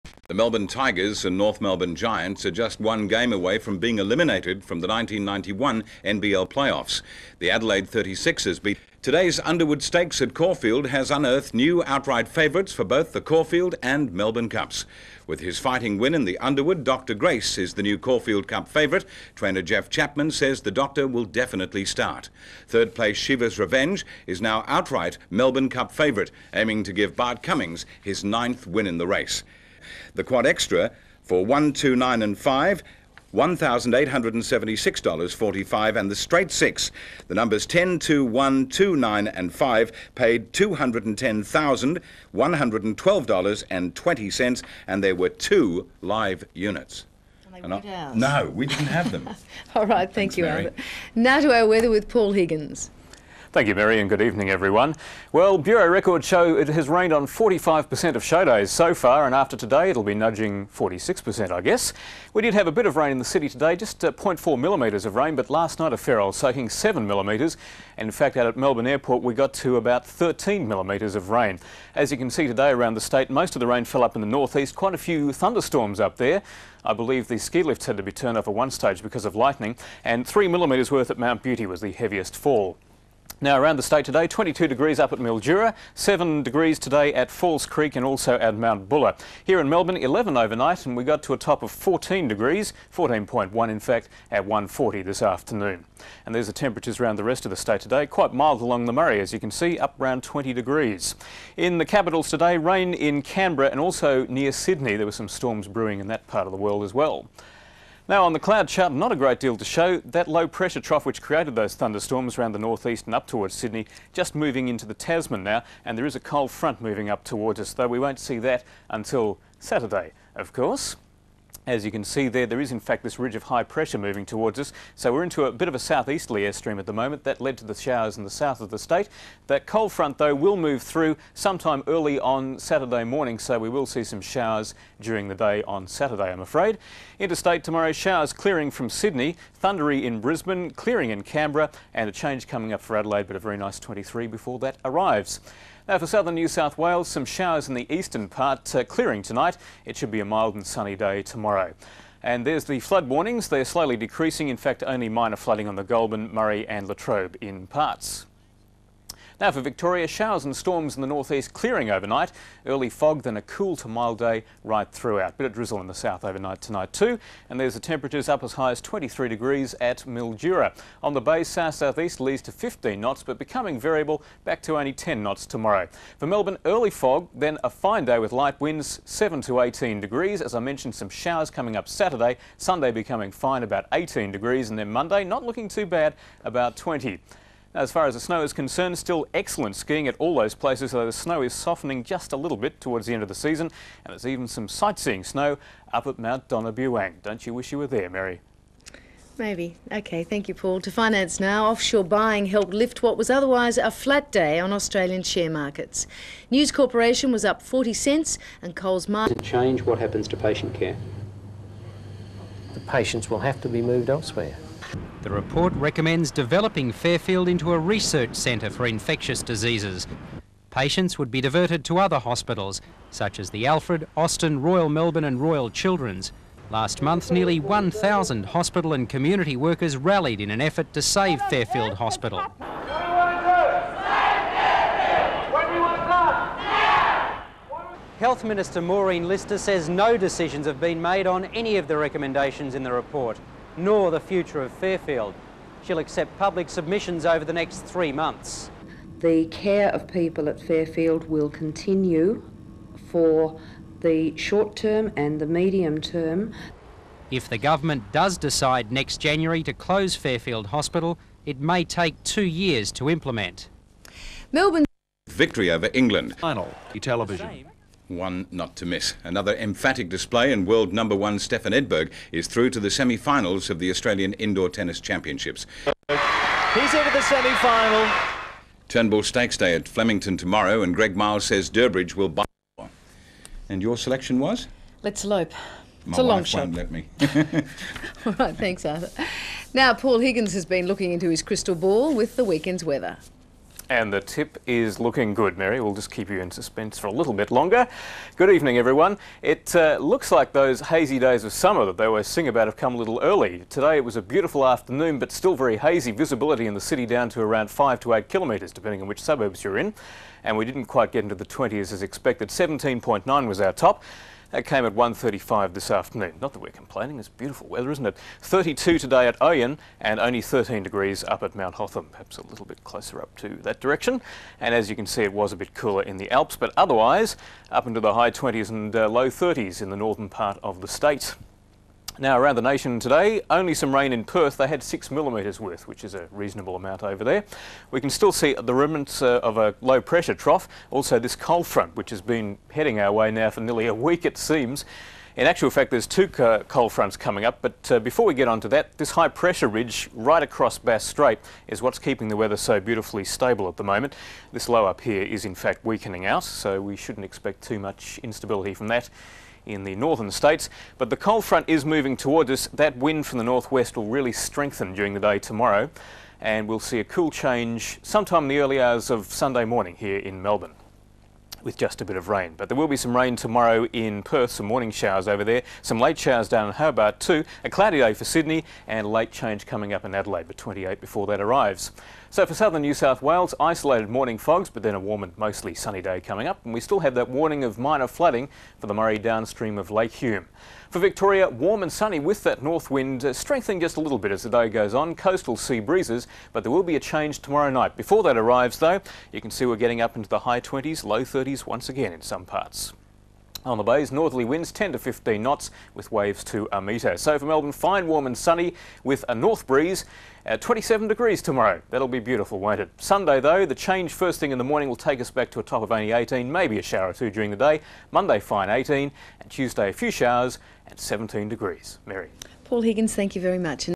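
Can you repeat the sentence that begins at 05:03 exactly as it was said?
Today it was a beautiful afternoon, but still very hazy.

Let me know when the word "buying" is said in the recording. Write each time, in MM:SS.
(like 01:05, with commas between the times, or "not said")
03:22.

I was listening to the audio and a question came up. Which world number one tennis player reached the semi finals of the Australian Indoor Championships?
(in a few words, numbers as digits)
Stefan Edberg.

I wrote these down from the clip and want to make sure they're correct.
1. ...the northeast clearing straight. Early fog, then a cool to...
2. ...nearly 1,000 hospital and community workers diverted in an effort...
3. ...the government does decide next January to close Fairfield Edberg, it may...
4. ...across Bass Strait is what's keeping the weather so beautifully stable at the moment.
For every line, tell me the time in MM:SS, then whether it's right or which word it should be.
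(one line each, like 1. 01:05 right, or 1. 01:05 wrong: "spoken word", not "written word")
1. 02:41 wrong: "overnight", not "straight"
2. 03:47 wrong: "rallied", not "diverted"
3. 04:17 wrong: "Hospital", not "Edberg"
4. 05:50 right.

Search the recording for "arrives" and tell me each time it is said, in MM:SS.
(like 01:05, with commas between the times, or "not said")
02:24, 06:21, 06:38.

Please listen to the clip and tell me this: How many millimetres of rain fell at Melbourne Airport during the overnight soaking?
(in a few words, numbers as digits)
13 millimetres.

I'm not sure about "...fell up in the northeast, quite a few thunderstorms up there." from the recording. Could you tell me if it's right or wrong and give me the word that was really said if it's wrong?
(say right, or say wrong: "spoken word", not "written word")
right.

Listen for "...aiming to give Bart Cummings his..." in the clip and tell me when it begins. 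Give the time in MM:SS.
00:26.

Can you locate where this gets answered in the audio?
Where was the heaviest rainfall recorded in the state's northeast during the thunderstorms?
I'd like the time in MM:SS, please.
01:21.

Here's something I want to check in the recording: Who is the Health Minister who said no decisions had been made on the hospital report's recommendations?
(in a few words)
Maureen Lyster.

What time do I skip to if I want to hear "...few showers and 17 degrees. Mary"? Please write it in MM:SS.
06:59.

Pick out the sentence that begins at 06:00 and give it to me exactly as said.
But the cold front is moving towards us.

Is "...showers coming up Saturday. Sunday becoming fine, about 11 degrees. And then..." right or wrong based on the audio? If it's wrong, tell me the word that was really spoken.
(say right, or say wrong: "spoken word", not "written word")
wrong: "18", not "11".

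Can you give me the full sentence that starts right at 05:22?
Perhaps a little bit closer up to that direction.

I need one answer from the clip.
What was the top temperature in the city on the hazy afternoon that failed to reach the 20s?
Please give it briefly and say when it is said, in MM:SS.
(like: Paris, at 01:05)
17.9, at 05:12.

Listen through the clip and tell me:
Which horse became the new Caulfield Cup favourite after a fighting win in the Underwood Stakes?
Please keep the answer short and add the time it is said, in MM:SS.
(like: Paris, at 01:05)
Dr. Grace, at 00:16.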